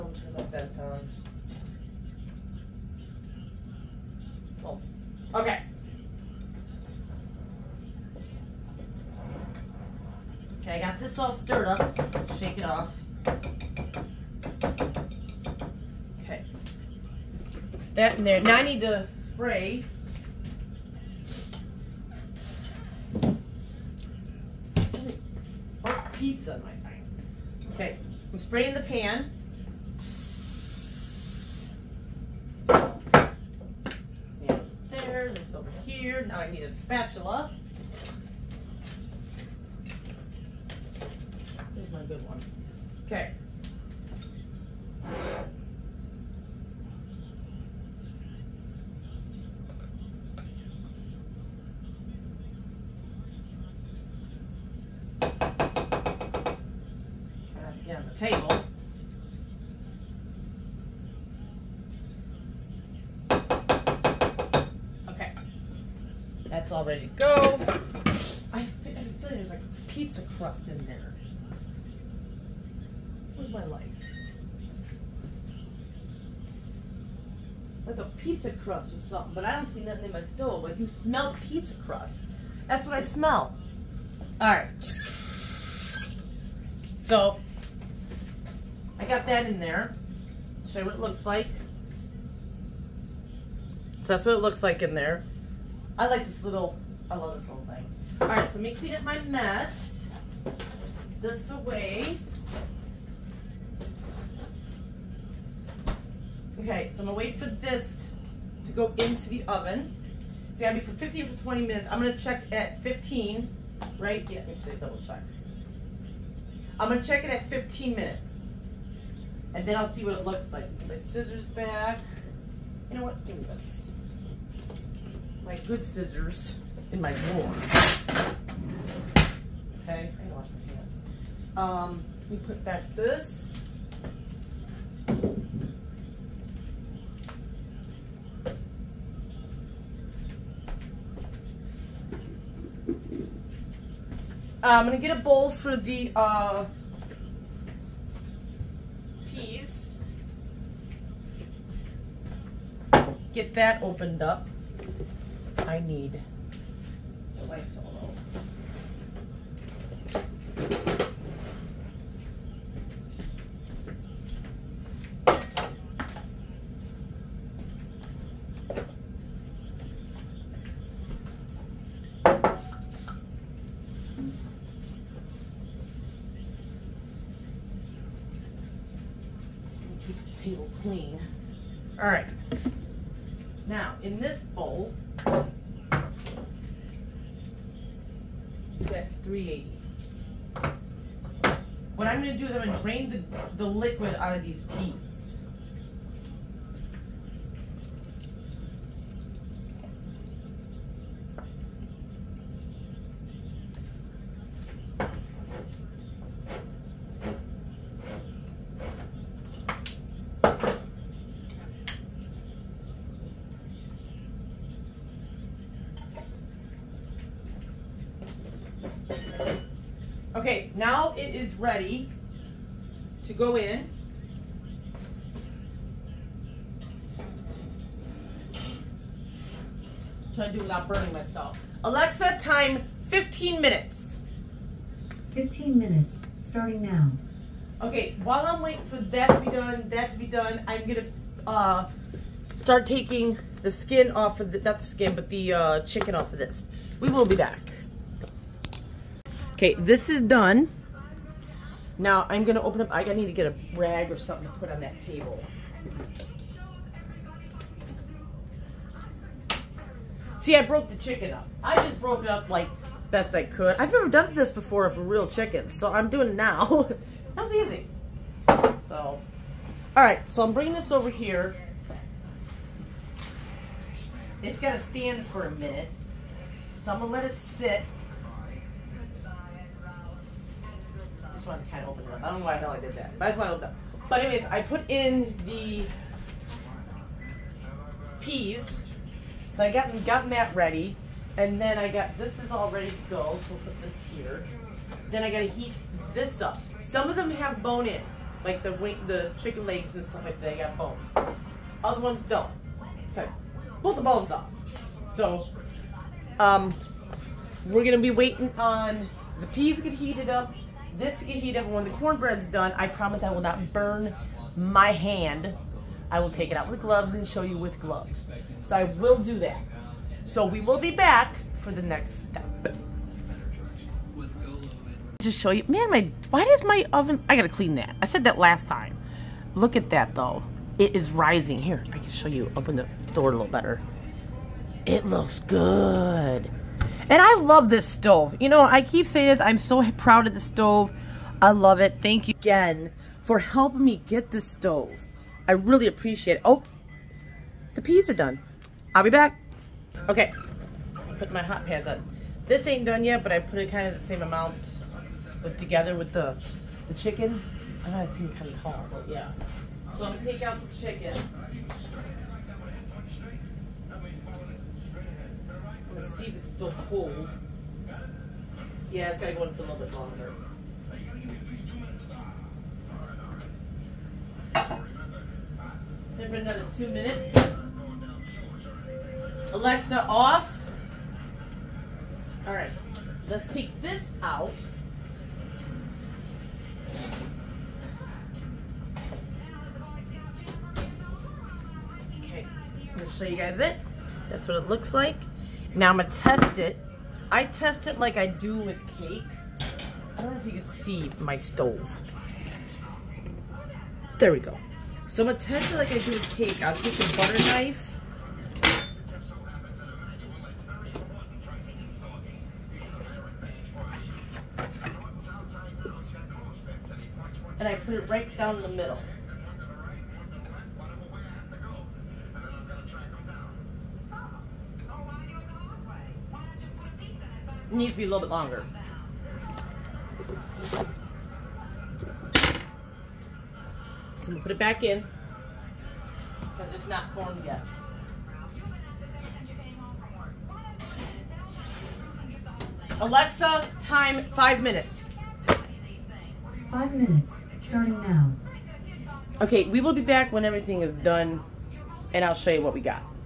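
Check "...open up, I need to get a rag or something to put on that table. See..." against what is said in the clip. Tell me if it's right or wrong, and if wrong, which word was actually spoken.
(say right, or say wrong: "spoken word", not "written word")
right.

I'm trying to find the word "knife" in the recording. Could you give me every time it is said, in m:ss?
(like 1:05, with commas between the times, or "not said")
6:47.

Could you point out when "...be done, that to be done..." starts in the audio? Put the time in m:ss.
3:59.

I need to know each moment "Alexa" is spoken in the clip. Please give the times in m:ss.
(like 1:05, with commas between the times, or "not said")
3:51, 6:19, 7:22.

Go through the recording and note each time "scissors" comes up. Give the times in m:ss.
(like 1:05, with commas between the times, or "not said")
2:00, 2:05.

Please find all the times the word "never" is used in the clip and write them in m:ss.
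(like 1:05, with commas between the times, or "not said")
4:23.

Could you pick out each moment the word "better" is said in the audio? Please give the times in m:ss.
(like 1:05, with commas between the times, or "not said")
5:33.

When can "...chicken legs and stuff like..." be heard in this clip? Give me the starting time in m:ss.
4:59.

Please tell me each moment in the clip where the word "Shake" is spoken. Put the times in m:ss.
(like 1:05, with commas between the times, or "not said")
0:12.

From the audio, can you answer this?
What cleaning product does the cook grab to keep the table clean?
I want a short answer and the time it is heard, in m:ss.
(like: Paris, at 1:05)
Lysol, at 2:37.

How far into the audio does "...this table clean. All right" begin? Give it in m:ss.
3:00.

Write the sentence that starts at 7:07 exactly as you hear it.
needs to be a little bit longer.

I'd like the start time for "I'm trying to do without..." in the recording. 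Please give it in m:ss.
3:50.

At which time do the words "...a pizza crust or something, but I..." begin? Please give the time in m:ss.
1:17.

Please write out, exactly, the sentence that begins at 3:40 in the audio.
Okay, now it is ready to go in.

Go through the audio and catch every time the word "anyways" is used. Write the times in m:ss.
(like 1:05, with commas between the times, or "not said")
4:44.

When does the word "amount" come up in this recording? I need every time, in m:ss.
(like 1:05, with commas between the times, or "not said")
5:54.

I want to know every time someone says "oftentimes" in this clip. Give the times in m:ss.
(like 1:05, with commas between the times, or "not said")
not said.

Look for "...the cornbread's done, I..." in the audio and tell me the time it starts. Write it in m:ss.
5:11.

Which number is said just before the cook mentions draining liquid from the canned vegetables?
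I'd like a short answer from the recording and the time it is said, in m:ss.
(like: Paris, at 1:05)
380, at 3:09.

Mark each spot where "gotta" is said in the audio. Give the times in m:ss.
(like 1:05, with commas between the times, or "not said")
4:34, 4:55, 5:27.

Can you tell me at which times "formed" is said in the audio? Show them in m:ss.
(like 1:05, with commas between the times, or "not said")
7:17.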